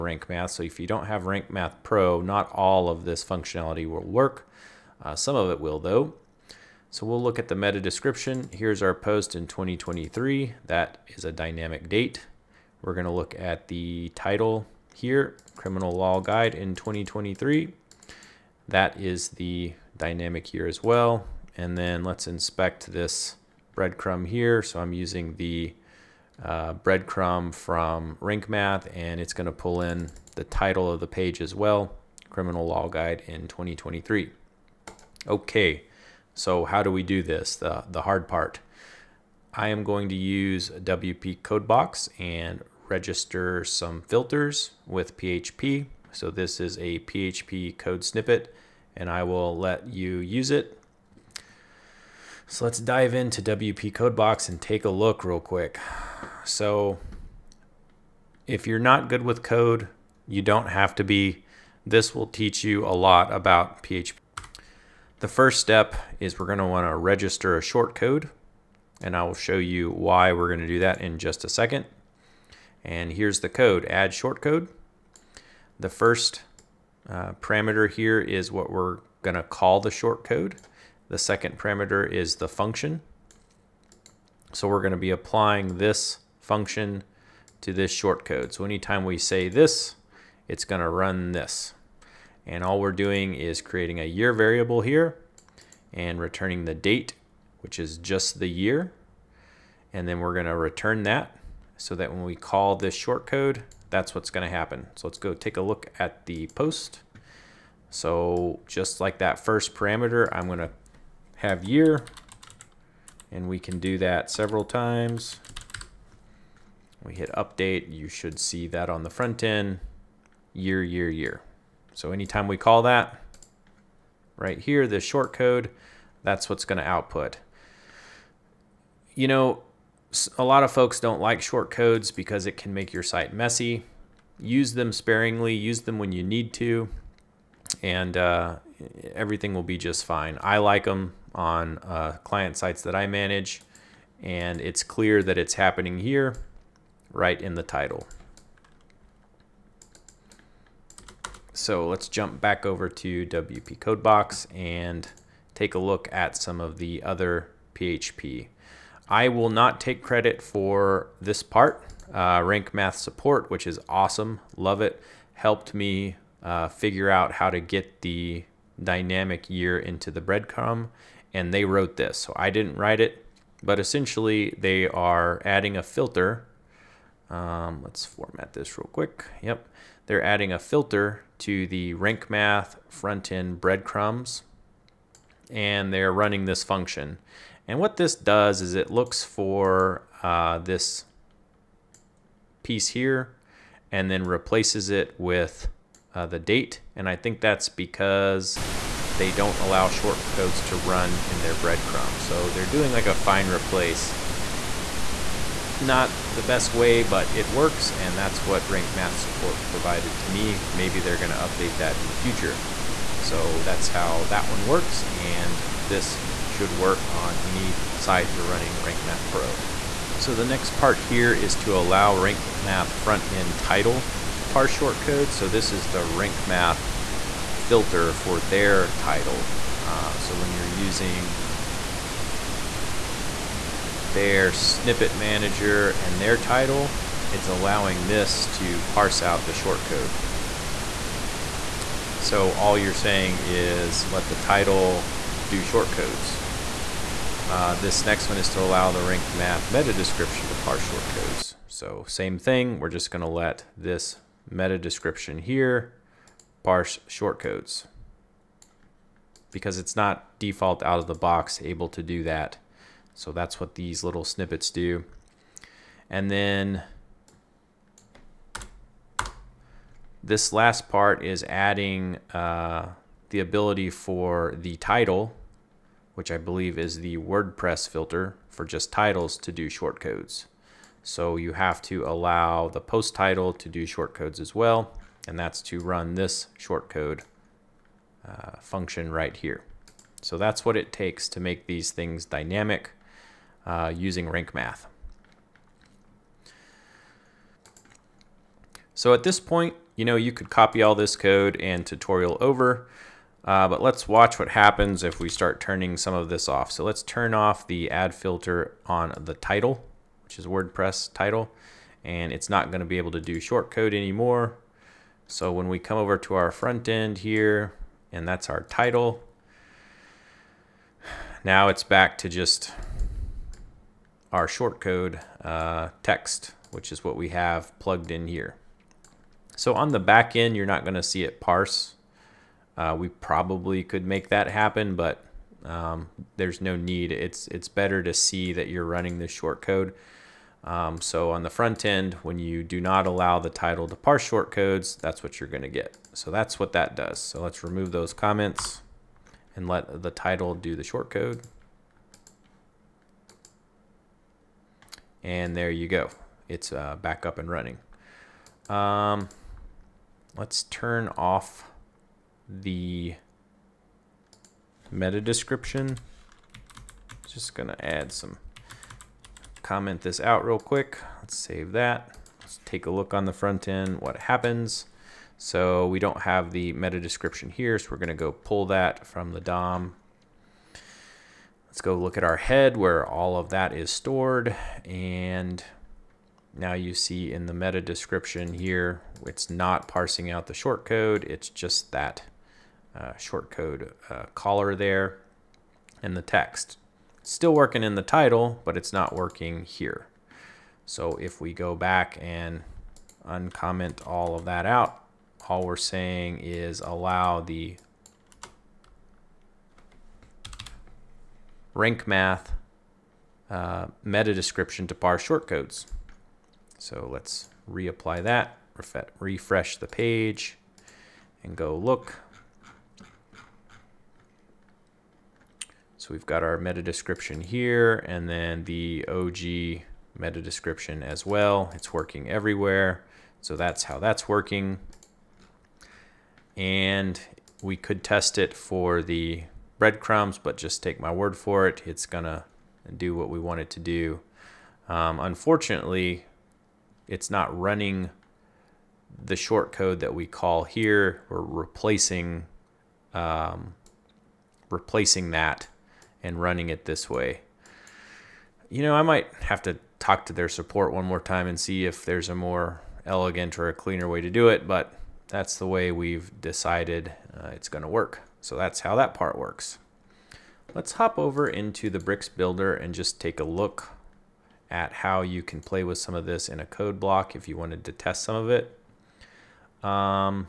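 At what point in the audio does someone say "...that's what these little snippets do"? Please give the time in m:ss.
4:23.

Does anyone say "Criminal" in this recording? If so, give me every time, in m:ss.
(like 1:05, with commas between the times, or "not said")
0:15, 0:32.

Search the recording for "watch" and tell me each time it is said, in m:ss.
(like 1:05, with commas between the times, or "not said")
5:04.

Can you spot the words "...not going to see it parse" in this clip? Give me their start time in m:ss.
5:30.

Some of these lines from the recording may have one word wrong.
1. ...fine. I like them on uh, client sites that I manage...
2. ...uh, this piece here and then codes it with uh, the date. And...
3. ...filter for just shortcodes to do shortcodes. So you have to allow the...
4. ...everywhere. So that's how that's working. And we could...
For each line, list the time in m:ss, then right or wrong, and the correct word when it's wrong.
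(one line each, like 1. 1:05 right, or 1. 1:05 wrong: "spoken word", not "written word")
1. 2:20 right
2. 3:10 wrong: "replaces", not "codes"
3. 4:37 wrong: "titles", not "shortcodes"
4. 7:12 right.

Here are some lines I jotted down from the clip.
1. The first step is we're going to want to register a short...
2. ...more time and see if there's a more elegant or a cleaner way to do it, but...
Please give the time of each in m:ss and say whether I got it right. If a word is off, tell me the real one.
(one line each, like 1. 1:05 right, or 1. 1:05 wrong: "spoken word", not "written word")
1. 1:05 right
2. 7:41 right.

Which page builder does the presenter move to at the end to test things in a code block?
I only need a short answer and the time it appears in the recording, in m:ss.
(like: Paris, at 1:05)
Bricks Builder, at 7:51.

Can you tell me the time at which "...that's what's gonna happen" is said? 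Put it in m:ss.
1:43.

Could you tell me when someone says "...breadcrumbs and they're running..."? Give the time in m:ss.
3:03.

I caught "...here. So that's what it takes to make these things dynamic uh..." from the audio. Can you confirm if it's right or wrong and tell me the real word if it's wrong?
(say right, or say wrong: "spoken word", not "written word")
right.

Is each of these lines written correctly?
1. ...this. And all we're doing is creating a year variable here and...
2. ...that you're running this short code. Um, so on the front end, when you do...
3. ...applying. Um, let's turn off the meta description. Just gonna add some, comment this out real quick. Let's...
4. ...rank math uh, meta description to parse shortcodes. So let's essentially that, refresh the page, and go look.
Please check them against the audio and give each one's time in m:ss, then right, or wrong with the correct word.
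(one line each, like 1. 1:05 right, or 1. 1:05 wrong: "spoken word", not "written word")
1. 1:31 right
2. 5:38 right
3. 5:57 wrong: "running", not "applying"
4. 6:51 wrong: "reapply", not "essentially".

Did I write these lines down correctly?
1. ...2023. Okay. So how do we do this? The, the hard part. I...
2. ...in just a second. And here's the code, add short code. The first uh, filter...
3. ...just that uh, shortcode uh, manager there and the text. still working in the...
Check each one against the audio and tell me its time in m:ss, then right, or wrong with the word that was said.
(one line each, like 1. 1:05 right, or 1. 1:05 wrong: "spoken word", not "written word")
1. 0:33 right
2. 1:11 wrong: "parameter", not "filter"
3. 6:31 wrong: "caller", not "manager".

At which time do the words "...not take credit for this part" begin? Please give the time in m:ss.
2:39.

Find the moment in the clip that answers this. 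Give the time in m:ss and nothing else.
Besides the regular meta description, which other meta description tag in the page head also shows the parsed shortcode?
7:09.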